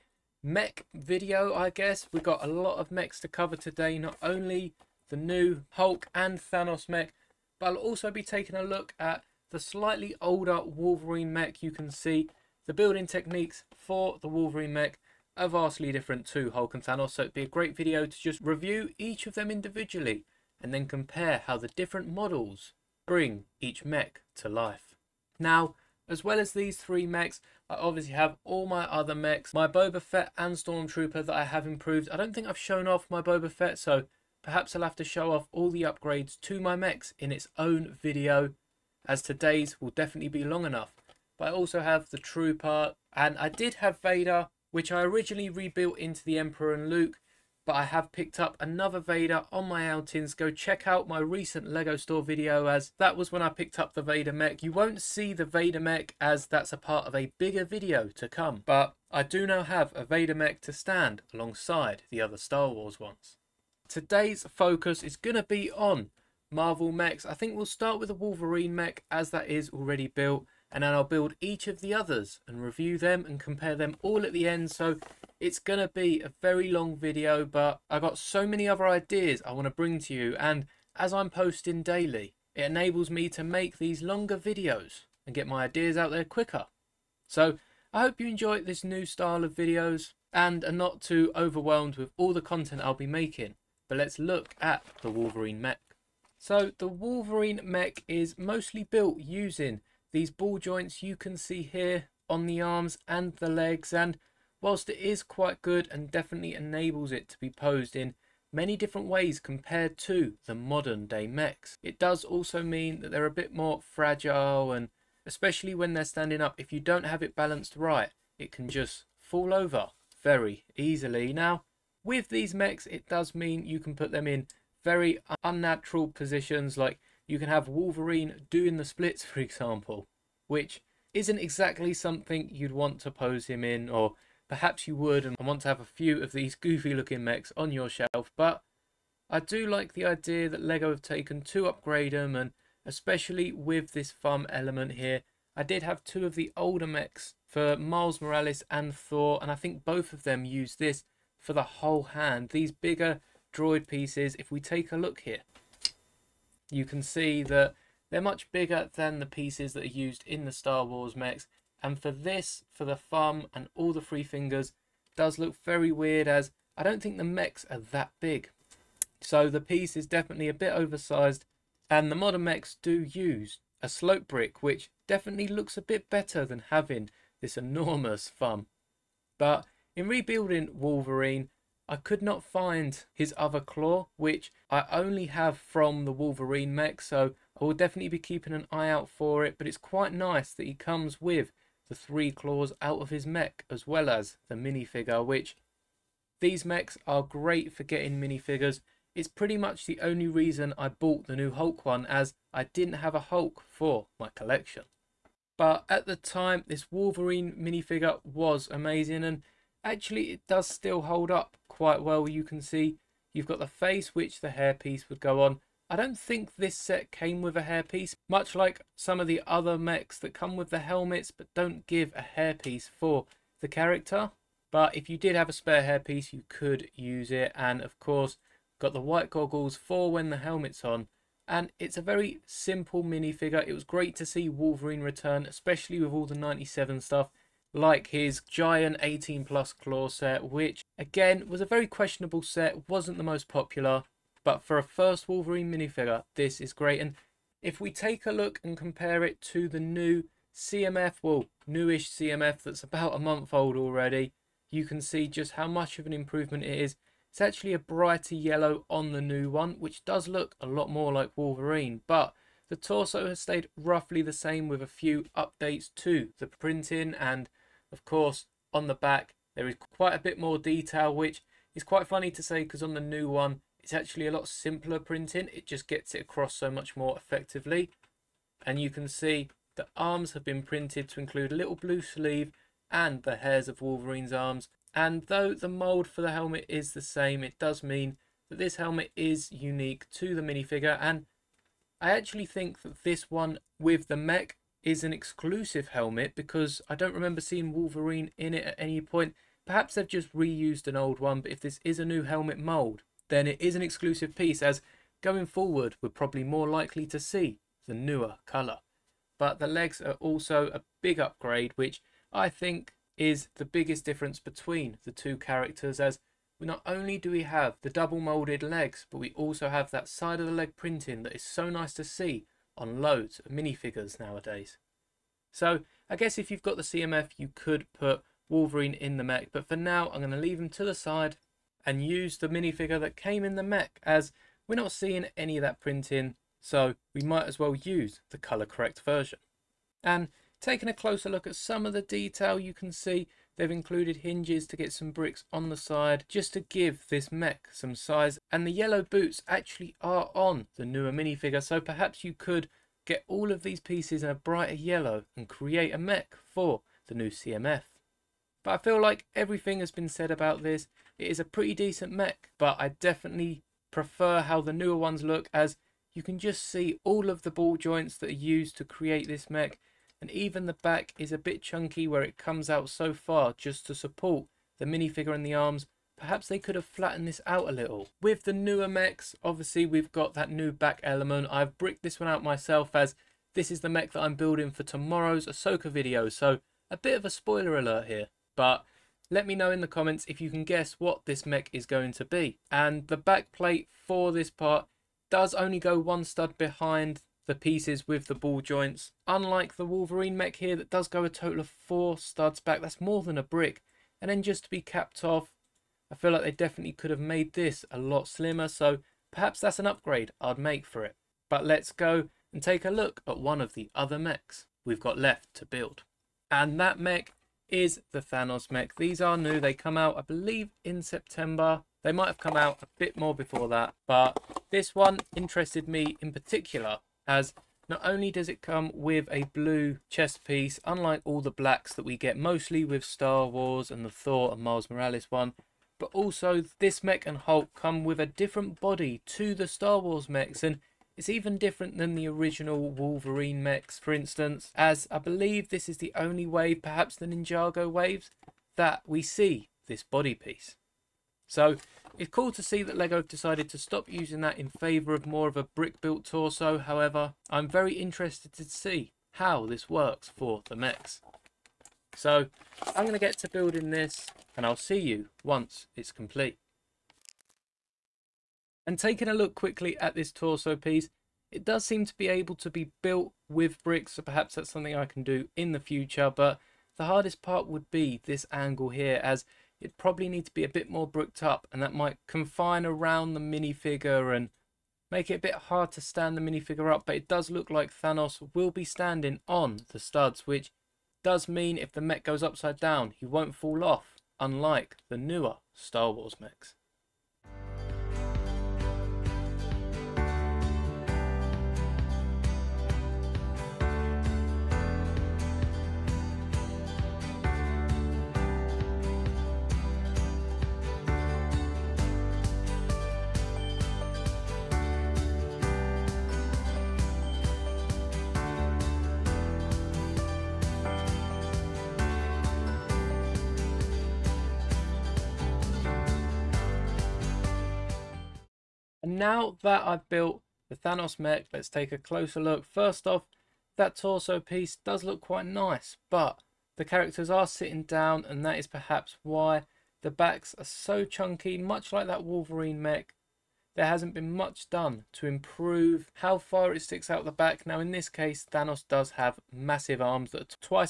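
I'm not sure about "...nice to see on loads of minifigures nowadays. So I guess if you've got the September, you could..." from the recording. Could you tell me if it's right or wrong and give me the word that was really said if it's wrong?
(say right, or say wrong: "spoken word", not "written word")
wrong: "CMF", not "September".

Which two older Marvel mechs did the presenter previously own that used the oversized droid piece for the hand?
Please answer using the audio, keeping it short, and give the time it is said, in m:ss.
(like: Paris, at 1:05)
Miles Morales and Thor, at 2:27.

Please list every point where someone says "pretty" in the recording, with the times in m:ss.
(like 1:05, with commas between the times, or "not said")
3:19, 6:01.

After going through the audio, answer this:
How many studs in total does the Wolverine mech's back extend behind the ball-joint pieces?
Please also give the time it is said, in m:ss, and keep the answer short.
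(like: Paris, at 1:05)
4, at 6:41.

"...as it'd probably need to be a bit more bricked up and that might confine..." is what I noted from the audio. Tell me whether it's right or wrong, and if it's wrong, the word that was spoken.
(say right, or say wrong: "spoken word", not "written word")
right.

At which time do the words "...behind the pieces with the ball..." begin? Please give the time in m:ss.
6:36.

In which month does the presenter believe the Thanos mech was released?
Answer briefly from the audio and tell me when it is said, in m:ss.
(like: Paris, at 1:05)
September, at 7:01.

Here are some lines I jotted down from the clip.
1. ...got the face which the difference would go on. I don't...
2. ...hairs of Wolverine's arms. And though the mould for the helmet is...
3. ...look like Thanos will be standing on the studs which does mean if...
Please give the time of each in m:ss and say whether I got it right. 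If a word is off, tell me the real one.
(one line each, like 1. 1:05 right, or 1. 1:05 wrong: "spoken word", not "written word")
1. 3:33 wrong: "hairpiece", not "difference"
2. 4:43 right
3. 8:07 right.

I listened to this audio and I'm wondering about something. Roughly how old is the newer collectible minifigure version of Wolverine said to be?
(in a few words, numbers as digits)
About a month.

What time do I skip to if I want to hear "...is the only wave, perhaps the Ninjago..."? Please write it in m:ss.
7:25.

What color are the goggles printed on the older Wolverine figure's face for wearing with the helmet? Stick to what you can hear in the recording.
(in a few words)
White.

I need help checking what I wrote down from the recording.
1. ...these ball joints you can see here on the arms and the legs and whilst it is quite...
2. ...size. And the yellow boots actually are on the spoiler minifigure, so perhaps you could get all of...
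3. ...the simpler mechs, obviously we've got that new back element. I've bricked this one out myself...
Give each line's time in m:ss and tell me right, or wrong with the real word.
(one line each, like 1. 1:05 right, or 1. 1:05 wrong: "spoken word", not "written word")
1. 1:40 right
2. 5:47 wrong: "newer", not "spoiler"
3. 6:18 wrong: "newer", not "simpler".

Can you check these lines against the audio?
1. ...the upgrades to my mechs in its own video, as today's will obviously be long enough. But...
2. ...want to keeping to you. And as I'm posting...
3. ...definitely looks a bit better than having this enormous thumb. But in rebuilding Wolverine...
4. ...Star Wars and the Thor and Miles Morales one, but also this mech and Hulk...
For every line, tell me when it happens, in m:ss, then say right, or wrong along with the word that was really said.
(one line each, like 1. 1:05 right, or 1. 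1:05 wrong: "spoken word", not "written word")
1. 0:35 wrong: "definitely", not "obviously"
2. 1:19 wrong: "bring", not "keeping"
3. 2:55 right
4. 7:13 right.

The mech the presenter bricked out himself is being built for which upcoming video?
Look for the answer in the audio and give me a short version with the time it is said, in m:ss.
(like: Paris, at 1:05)
Ahsoka video, at 6:25.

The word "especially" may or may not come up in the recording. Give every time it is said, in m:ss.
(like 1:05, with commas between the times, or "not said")
1:55, 2:22, 3:55.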